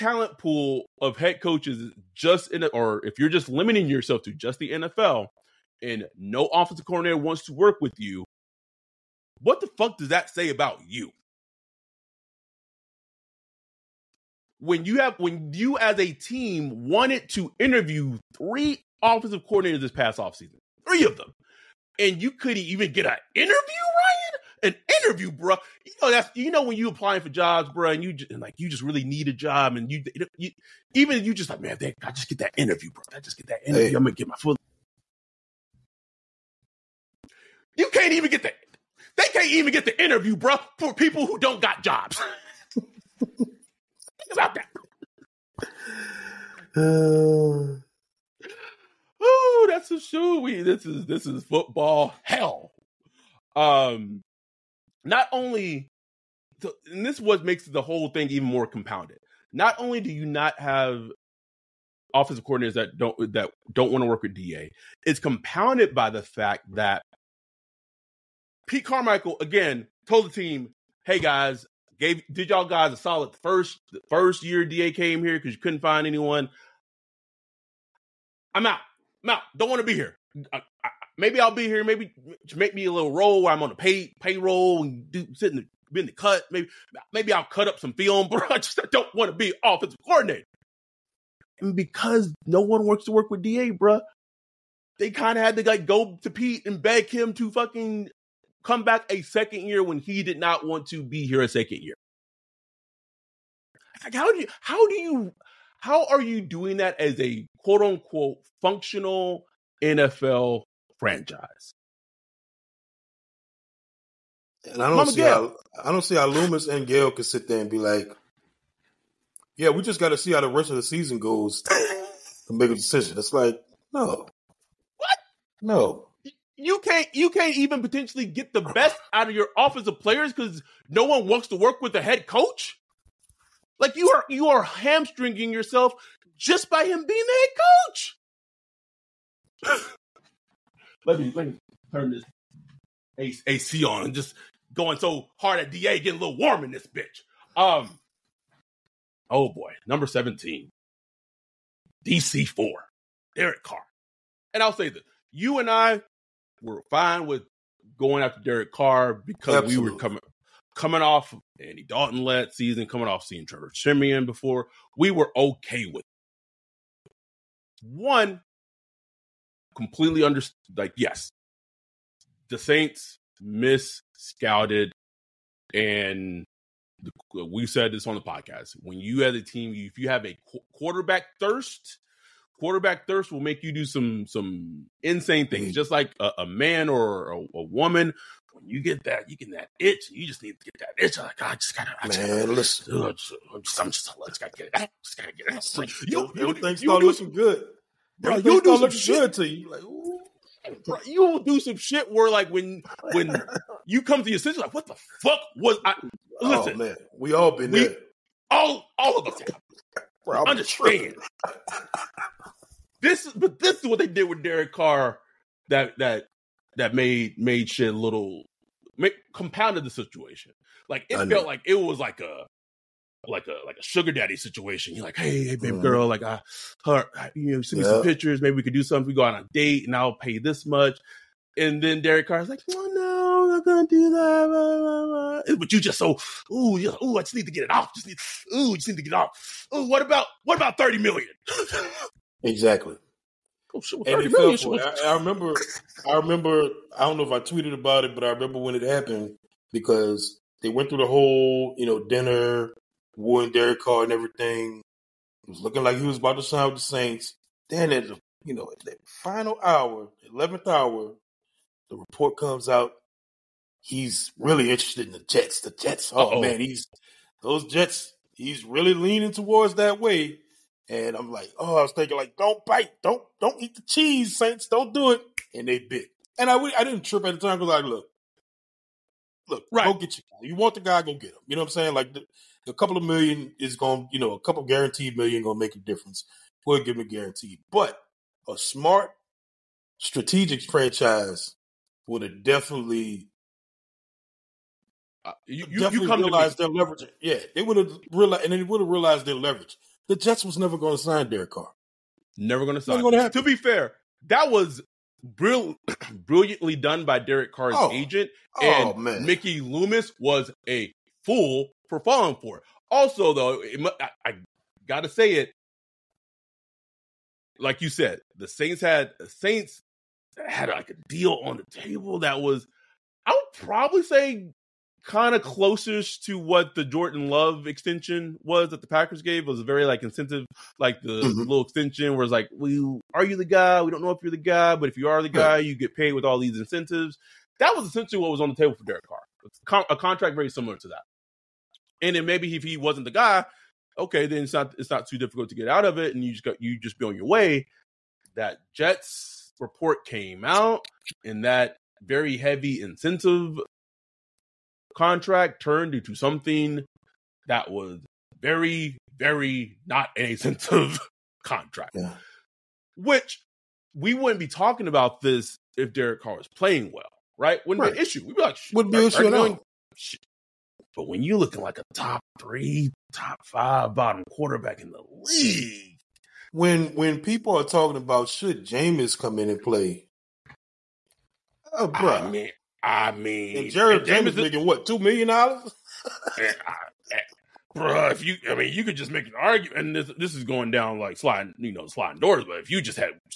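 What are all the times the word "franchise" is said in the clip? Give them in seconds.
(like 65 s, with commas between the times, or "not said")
110 s, 290 s.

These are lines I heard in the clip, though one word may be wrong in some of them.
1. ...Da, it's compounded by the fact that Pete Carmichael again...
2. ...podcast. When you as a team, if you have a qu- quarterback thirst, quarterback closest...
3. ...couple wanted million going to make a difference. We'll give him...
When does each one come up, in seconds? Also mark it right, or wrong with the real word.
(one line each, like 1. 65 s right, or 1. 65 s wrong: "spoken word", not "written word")
1. 64 s right
2. 178 s wrong: "thirst", not "closest"
3. 284 s wrong: "guaranteed", not "wanted".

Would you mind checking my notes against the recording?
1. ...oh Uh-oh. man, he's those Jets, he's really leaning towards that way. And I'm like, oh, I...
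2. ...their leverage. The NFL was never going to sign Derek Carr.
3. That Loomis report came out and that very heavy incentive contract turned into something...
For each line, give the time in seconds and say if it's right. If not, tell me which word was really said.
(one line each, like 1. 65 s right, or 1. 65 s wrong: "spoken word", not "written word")
1. 266 s right
2. 299 s wrong: "Jets", not "NFL"
3. 348 s wrong: "Jets", not "Loomis".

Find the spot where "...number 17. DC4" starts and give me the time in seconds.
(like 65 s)
149 s.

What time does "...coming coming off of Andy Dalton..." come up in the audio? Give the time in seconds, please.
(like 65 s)
159 s.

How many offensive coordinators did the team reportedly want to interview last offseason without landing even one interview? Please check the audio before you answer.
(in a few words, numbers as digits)
3.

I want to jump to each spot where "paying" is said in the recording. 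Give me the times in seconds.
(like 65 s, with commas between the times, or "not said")
not said.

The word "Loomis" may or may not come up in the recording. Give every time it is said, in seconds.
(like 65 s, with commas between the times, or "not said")
116 s, 309 s.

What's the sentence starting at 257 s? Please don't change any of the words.
Then at the, you know, at the final hour, eleventh hour, the report comes out.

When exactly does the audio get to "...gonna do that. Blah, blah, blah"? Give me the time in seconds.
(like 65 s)
233 s.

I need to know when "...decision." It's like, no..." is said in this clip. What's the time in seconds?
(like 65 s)
122 s.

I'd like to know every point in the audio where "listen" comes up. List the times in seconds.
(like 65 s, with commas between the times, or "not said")
192 s, 206 s.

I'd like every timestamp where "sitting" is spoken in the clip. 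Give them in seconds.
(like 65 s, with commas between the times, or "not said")
85 s.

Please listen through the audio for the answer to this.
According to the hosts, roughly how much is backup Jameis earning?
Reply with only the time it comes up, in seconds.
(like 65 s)
384 s.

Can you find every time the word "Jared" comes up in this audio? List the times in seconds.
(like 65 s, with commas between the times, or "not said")
383 s.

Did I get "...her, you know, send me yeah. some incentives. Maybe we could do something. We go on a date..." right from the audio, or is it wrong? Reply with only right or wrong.
wrong.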